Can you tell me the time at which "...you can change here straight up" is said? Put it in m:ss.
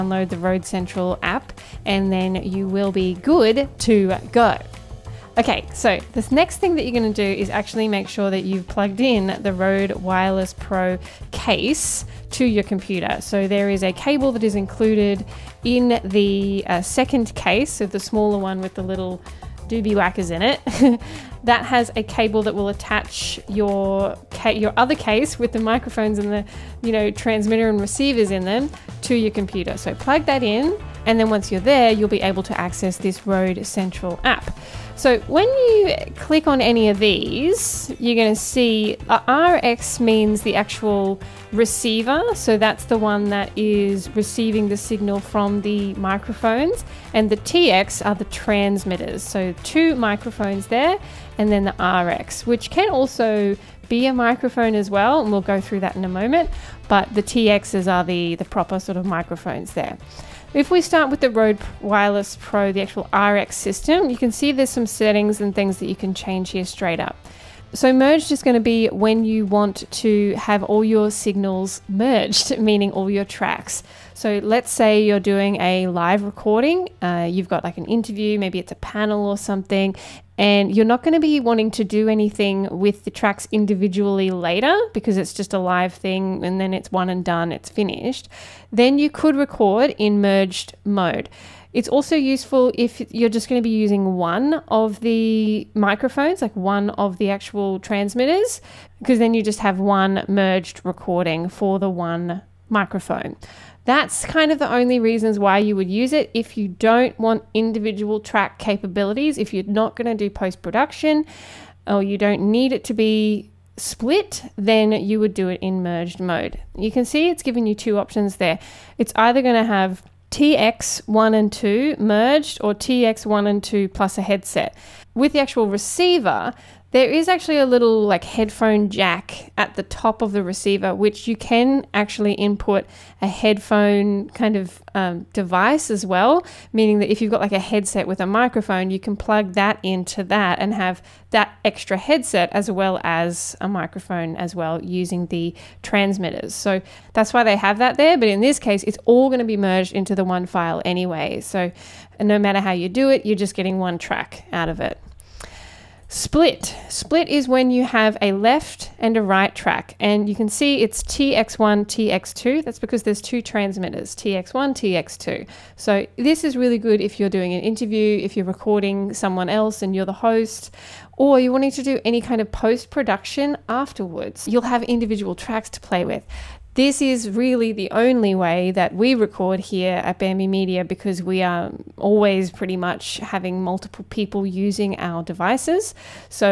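1:05.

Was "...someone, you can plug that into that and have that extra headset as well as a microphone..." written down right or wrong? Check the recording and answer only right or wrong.
wrong.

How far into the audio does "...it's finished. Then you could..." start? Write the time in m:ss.
1:27.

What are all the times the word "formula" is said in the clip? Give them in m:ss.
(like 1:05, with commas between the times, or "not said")
not said.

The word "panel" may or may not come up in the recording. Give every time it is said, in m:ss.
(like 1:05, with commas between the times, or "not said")
1:18.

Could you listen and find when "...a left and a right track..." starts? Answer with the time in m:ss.
2:38.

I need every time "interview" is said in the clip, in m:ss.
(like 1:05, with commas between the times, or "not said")
1:17, 2:47.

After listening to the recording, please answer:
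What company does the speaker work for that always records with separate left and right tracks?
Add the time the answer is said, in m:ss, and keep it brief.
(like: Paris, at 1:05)
Bamby Media, at 3:00.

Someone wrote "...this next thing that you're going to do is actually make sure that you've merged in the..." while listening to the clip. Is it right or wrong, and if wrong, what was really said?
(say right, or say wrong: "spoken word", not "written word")
wrong: "plugged", not "merged".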